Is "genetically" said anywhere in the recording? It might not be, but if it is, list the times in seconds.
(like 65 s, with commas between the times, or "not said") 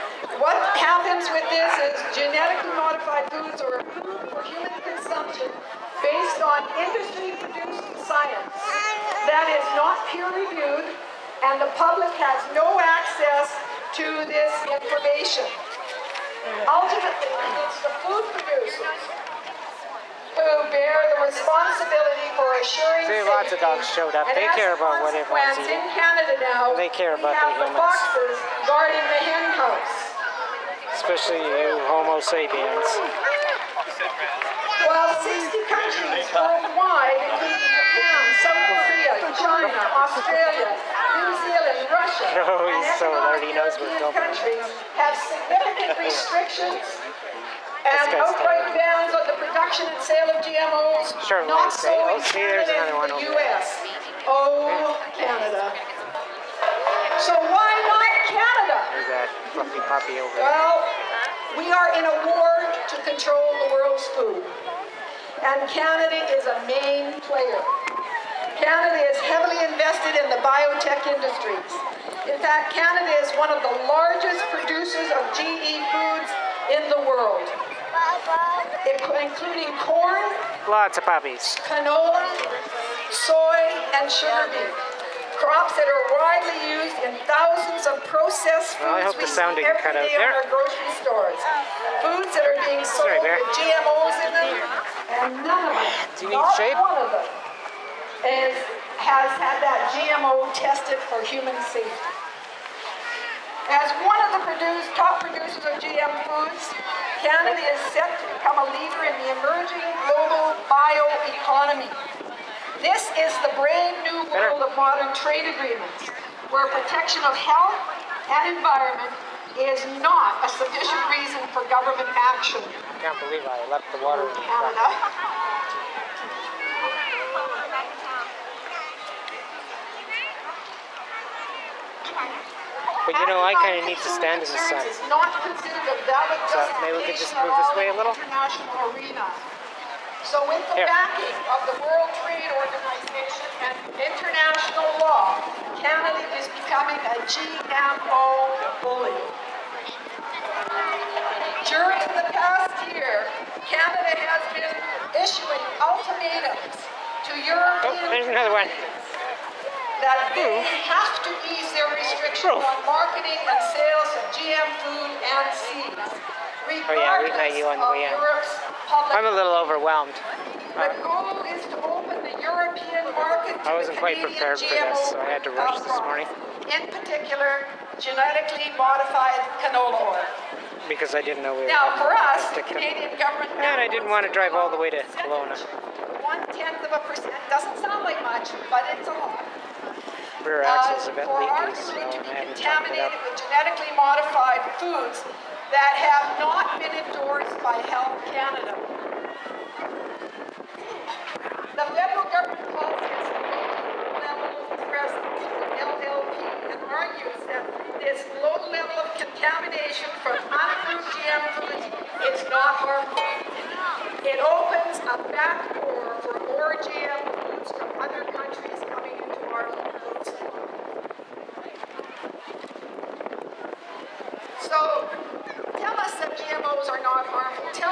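2 s, 177 s, 193 s.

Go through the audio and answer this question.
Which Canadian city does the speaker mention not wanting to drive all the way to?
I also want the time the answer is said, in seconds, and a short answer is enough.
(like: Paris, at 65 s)
Kelowna, at 185 s.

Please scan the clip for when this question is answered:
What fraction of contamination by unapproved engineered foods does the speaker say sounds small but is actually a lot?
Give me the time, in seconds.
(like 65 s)
186 s.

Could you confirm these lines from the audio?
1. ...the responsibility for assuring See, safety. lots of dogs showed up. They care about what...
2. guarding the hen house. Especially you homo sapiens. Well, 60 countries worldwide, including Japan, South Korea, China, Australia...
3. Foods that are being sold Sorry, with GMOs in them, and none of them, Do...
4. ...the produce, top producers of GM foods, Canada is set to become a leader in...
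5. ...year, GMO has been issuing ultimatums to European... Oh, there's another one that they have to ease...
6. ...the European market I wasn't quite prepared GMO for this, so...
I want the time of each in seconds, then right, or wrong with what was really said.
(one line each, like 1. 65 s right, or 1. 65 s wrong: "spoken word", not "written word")
1. 21 s right
2. 28 s right
3. 92 s right
4. 104 s right
5. 152 s wrong: "Canada", not "GMO"
6. 172 s right.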